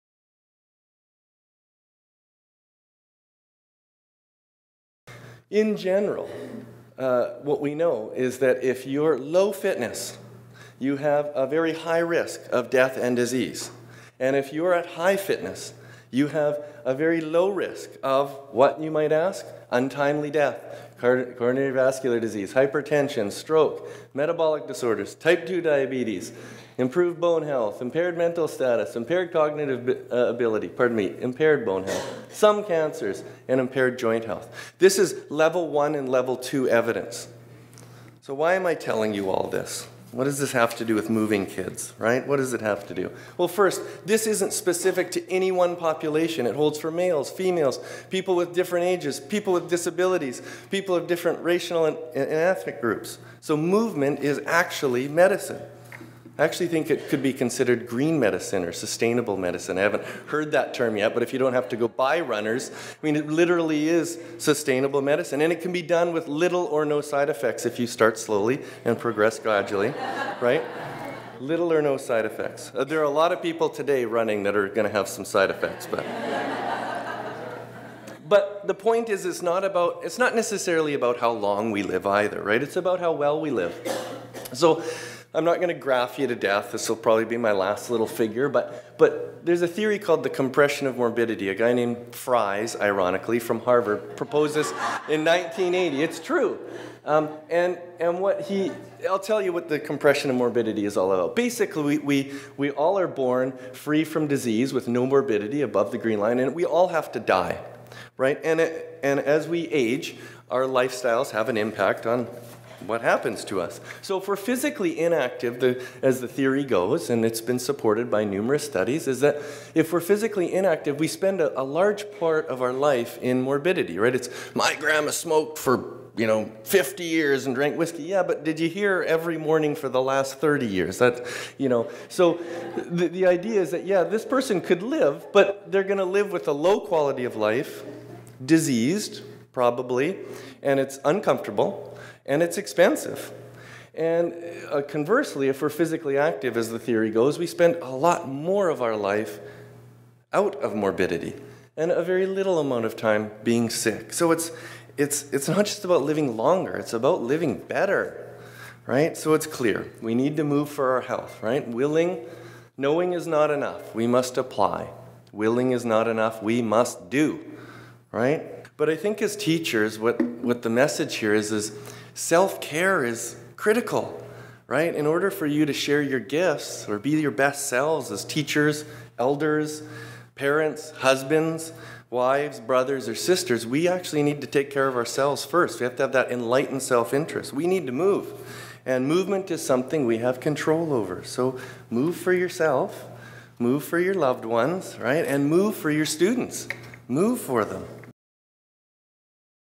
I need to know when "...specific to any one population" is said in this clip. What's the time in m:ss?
0:44.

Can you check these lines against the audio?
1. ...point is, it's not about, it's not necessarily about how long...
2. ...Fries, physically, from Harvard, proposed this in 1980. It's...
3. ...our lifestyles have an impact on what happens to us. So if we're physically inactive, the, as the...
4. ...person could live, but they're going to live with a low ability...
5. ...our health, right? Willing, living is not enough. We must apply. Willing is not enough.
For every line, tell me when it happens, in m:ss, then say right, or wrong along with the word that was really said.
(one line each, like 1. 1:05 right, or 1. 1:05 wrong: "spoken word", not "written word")
1. 1:18 right
2. 1:32 wrong: "ironically", not "physically"
3. 1:50 right
4. 2:14 wrong: "quality", not "ability"
5. 2:40 wrong: "knowing", not "living".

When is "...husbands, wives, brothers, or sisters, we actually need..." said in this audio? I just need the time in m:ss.
3:00.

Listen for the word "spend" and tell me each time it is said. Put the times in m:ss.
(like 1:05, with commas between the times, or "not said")
2:01, 2:27.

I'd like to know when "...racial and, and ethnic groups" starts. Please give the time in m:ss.
0:51.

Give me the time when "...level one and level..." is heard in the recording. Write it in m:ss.
0:35.